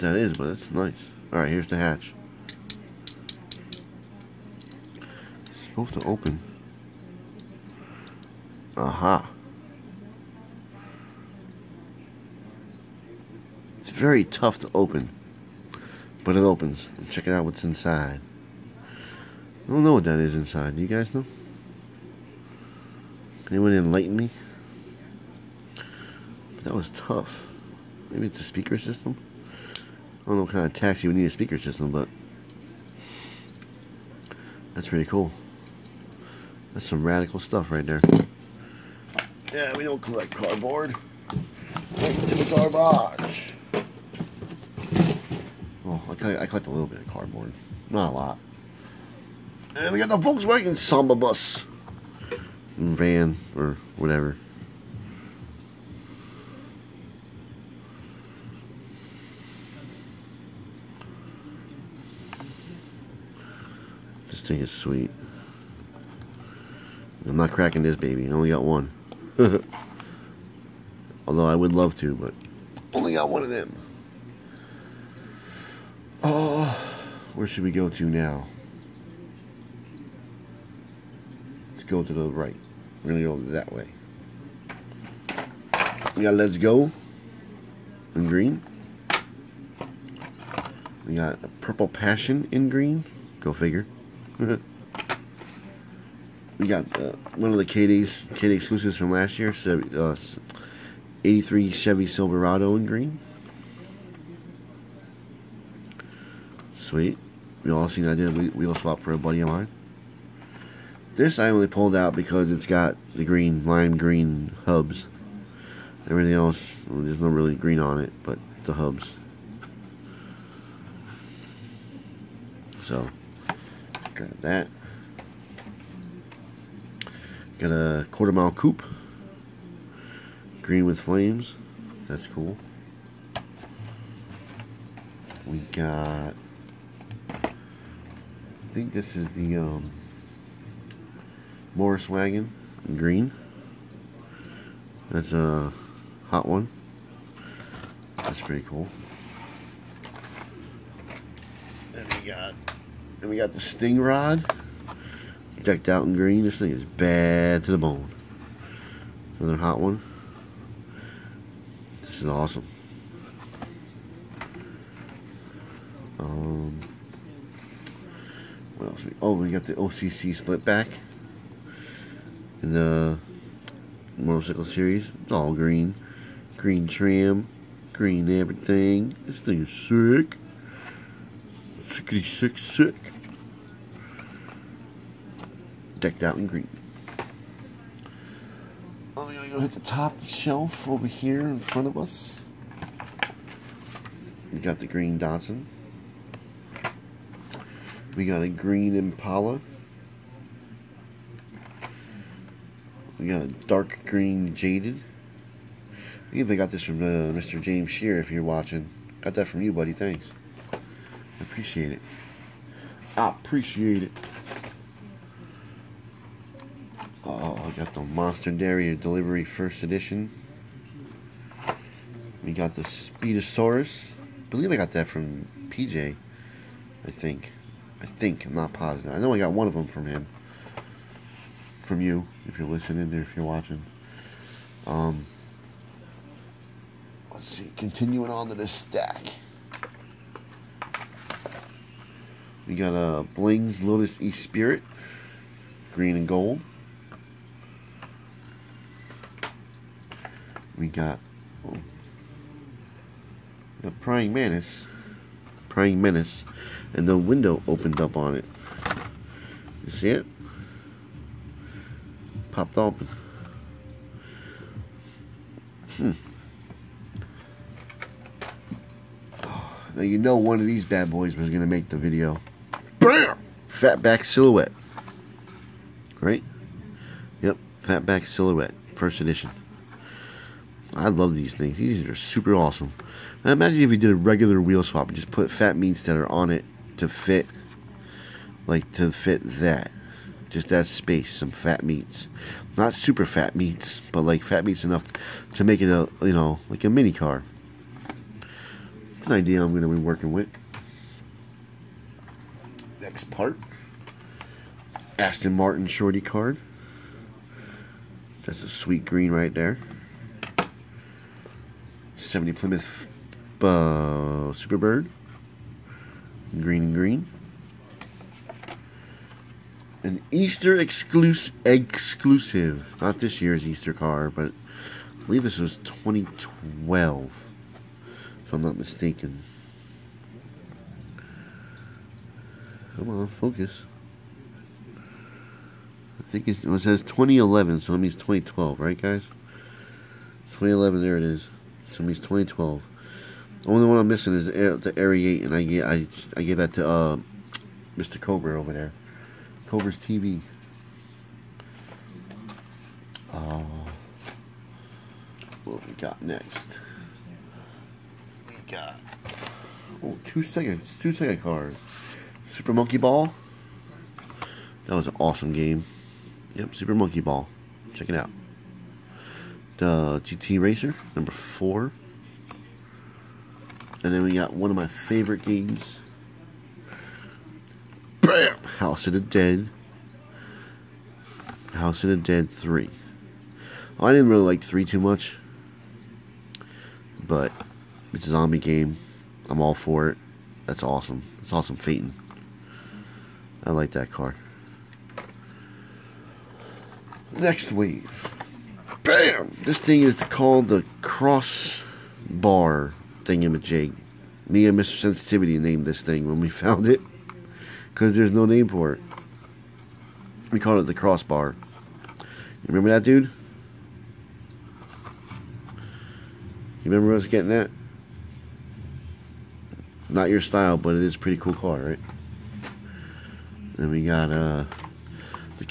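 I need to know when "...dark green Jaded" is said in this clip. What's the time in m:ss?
3:23.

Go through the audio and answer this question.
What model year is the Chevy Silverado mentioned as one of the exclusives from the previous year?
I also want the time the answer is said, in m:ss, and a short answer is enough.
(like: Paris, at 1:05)
83, at 1:41.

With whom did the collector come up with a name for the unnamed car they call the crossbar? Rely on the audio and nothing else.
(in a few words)
Mr. Sensitivity.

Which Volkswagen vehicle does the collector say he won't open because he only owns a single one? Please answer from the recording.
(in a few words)
Samba bus.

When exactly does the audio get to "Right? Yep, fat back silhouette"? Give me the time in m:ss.
4:36.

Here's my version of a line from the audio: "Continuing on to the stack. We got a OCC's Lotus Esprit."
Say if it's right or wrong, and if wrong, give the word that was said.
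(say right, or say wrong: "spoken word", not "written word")
wrong: "Bling", not "OCC".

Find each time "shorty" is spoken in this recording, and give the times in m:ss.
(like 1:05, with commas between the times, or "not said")
5:05.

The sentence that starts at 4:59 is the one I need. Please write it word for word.
an idea I'm going to be working with.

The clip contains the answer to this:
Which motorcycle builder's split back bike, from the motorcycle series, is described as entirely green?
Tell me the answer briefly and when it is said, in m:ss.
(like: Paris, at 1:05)
OCC, at 2:49.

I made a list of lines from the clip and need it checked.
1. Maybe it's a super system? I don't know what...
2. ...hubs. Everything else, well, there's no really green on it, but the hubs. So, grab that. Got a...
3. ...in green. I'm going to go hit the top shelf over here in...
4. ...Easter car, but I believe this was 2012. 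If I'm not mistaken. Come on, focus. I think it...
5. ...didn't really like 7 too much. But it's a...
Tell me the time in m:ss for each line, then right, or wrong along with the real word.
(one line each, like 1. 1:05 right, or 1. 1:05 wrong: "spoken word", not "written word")
1. 0:28 wrong: "speaker", not "super"
2. 1:54 right
3. 3:06 right
4. 5:23 right
5. 6:24 wrong: "3", not "7".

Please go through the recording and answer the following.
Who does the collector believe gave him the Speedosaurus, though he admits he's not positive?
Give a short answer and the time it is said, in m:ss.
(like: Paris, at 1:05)
PJ, at 3:45.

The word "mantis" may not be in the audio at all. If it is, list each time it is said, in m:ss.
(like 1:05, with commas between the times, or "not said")
4:14.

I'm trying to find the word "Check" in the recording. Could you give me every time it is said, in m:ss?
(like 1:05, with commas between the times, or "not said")
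0:17, 6:07.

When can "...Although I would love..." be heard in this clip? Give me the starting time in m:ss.
1:11.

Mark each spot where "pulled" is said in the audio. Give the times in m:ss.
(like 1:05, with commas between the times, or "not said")
1:51.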